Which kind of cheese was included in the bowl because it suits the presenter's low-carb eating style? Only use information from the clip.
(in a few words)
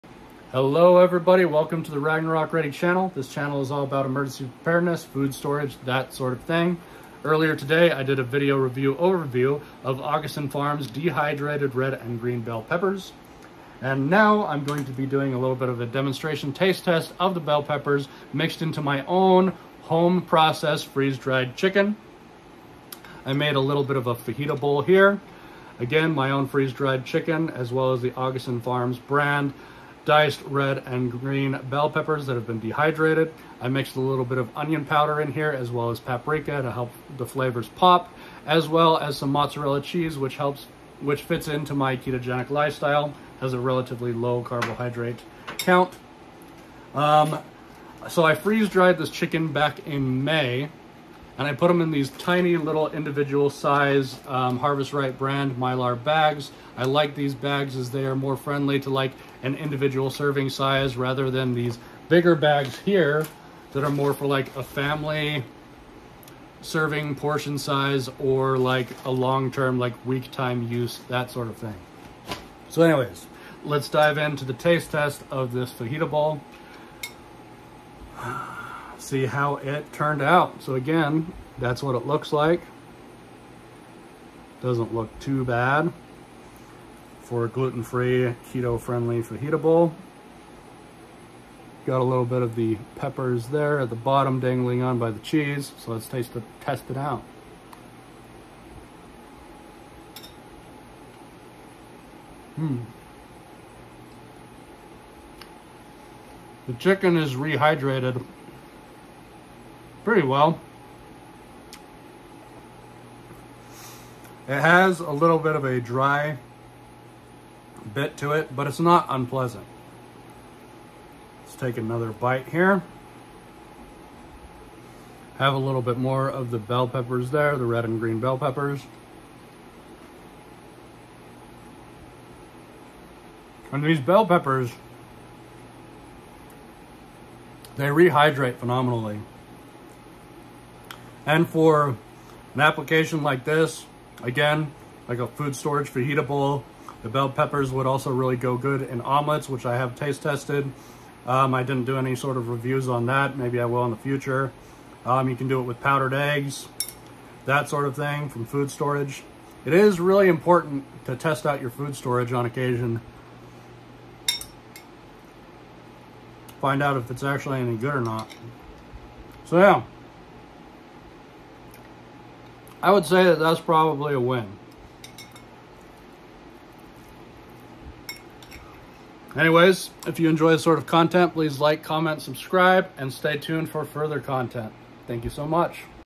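Mozzarella.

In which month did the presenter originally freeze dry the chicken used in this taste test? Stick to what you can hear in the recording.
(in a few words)
May.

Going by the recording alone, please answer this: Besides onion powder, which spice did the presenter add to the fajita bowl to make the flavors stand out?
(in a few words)
Paprika.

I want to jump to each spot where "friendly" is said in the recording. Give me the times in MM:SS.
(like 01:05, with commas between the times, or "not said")
00:58, 01:28.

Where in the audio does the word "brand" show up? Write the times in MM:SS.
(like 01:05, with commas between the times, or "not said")
00:28, 00:55.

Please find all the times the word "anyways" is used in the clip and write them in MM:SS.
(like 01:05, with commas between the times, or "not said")
01:12, 02:59.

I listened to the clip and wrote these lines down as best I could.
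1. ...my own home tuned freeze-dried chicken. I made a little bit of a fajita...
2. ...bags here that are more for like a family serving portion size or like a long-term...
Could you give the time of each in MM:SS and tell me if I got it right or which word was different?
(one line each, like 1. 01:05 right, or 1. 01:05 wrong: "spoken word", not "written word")
1. 00:18 wrong: "processed", not "tuned"
2. 01:02 right.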